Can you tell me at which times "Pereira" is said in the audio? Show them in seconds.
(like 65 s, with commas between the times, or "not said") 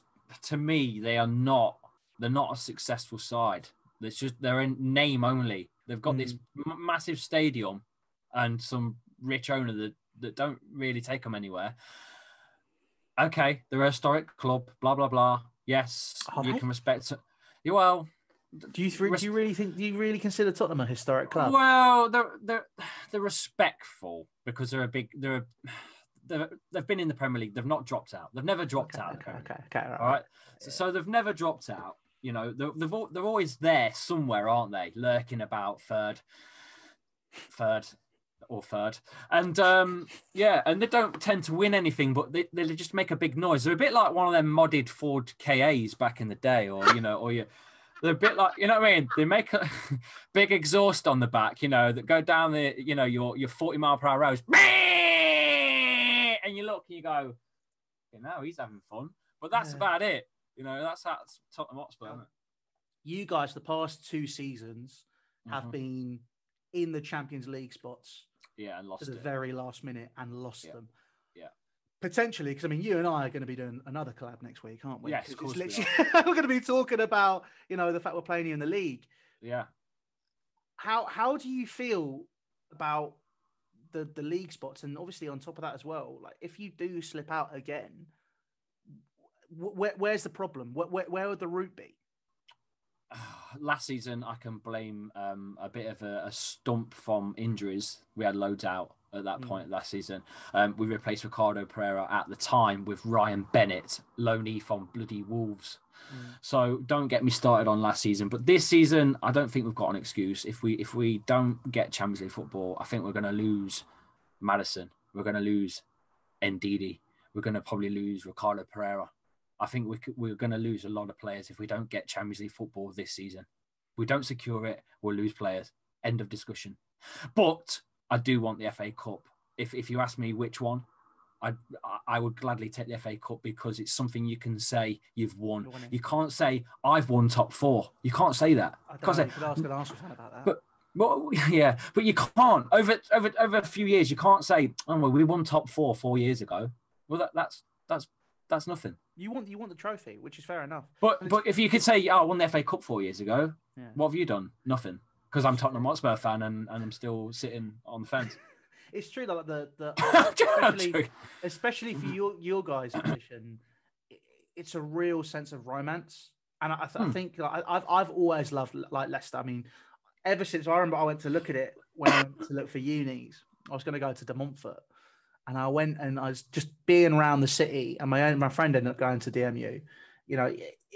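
101 s, 118 s.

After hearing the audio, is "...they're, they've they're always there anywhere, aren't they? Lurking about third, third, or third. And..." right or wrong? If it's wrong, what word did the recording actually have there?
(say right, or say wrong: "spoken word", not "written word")
wrong: "somewhere", not "anywhere".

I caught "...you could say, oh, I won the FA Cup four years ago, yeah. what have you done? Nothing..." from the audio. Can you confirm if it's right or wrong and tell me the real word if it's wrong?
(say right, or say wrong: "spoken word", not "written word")
right.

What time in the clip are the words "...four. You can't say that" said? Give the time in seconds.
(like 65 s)
137 s.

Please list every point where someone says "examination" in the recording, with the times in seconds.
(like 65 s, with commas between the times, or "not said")
not said.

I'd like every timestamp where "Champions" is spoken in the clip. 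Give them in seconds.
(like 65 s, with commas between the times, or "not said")
66 s, 111 s, 122 s.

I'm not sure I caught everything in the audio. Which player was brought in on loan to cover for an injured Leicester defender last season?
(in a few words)
Ryan Bennett.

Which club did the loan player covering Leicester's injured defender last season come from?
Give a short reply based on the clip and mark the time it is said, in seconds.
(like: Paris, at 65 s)
Wolves, at 105 s.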